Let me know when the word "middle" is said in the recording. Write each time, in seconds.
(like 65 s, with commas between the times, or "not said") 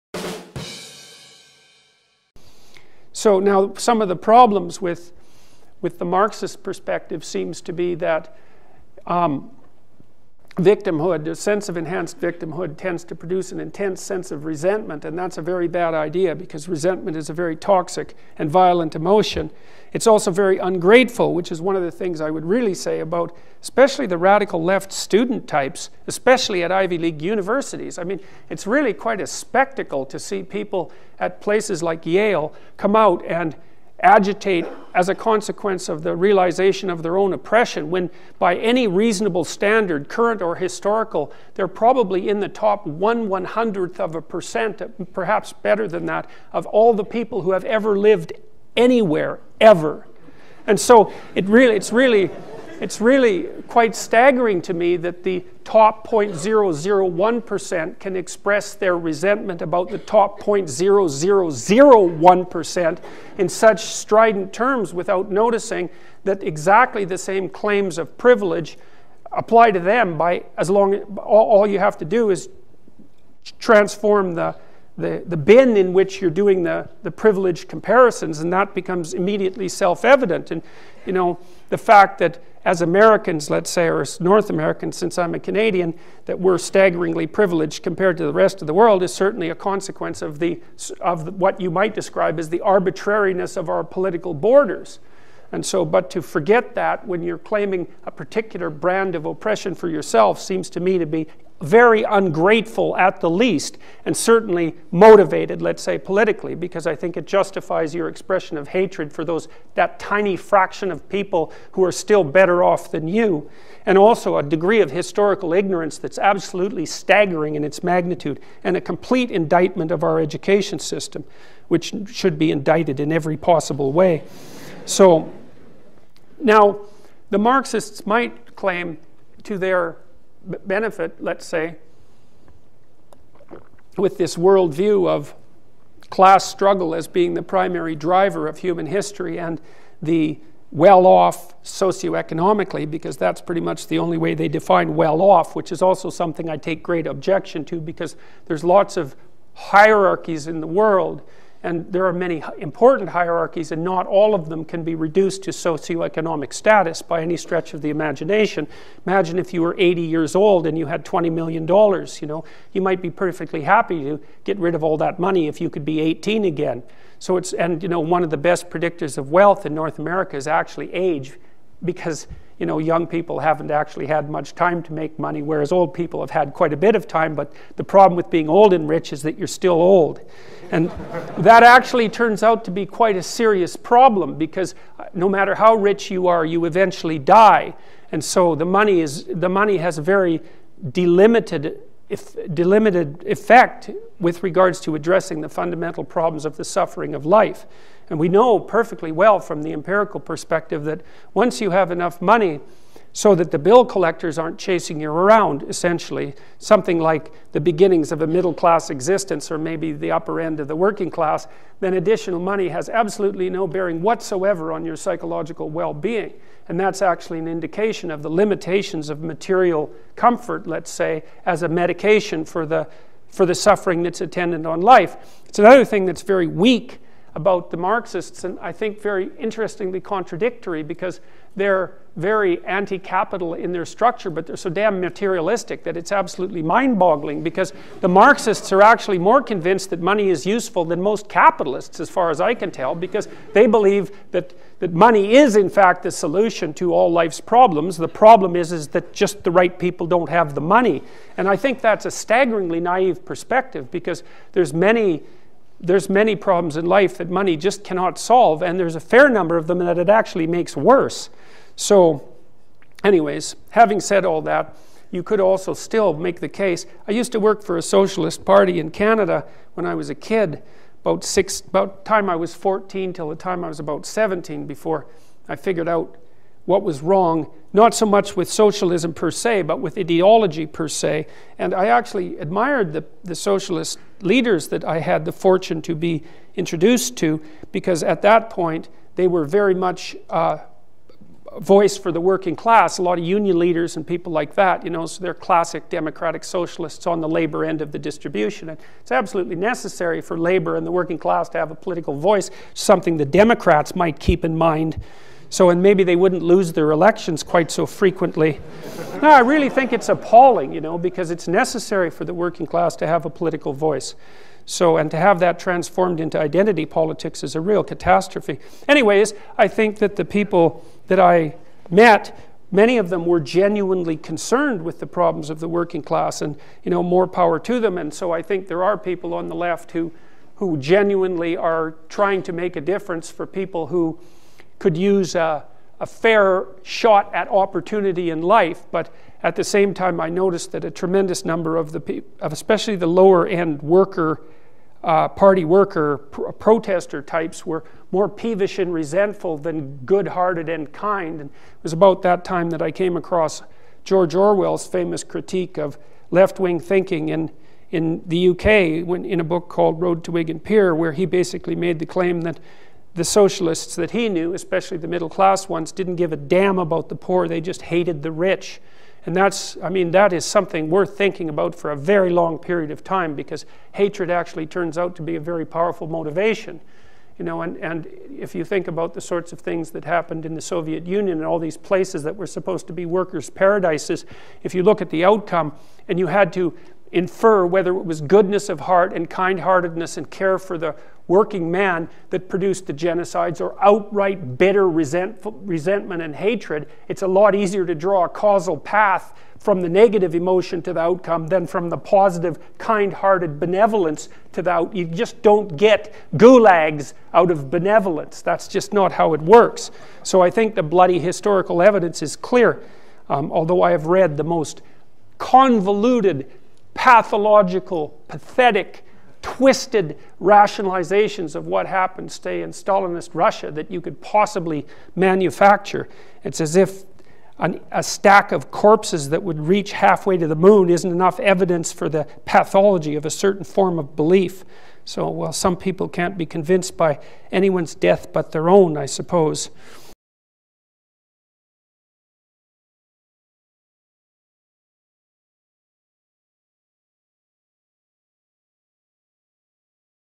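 208 s, 365 s.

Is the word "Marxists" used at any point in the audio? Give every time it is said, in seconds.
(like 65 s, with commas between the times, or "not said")
6 s, 127 s, 227 s, 238 s.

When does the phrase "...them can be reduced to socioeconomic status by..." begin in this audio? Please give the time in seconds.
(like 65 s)
154 s.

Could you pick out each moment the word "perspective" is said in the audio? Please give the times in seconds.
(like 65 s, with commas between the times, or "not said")
6 s, 200 s, 253 s.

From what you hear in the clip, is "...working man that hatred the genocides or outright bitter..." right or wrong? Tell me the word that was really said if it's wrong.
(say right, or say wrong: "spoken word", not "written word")
wrong: "produced", not "hatred".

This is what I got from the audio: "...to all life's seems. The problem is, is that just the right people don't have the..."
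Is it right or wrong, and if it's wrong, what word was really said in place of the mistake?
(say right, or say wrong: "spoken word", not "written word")
wrong: "problems", not "seems".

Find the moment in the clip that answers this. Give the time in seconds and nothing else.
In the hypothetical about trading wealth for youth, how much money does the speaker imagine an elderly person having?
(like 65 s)
161 s.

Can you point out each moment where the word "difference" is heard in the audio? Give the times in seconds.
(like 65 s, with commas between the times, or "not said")
332 s.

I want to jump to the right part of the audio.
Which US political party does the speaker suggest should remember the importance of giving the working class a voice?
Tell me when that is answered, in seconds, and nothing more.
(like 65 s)
303 s.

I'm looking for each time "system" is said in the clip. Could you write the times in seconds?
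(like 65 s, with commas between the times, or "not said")
120 s.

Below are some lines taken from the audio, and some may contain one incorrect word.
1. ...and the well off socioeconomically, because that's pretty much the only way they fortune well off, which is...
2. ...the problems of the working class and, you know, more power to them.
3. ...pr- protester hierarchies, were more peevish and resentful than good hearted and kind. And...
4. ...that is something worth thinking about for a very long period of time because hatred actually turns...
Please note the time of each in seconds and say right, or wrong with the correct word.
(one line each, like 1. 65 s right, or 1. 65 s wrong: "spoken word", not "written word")
1. 139 s wrong: "define", not "fortune"
2. 325 s right
3. 346 s wrong: "types", not "hierarchies"
4. 370 s right.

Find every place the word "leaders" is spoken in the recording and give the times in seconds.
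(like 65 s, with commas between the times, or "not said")
284 s, 293 s.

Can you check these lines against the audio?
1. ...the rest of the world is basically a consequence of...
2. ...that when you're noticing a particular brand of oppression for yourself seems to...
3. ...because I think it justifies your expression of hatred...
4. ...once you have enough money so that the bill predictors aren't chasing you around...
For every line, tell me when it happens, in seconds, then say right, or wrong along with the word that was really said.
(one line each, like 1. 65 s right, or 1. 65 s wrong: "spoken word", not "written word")
1. 88 s wrong: "certainly", not "basically"
2. 96 s wrong: "claiming", not "noticing"
3. 106 s right
4. 201 s wrong: "collectors", not "predictors".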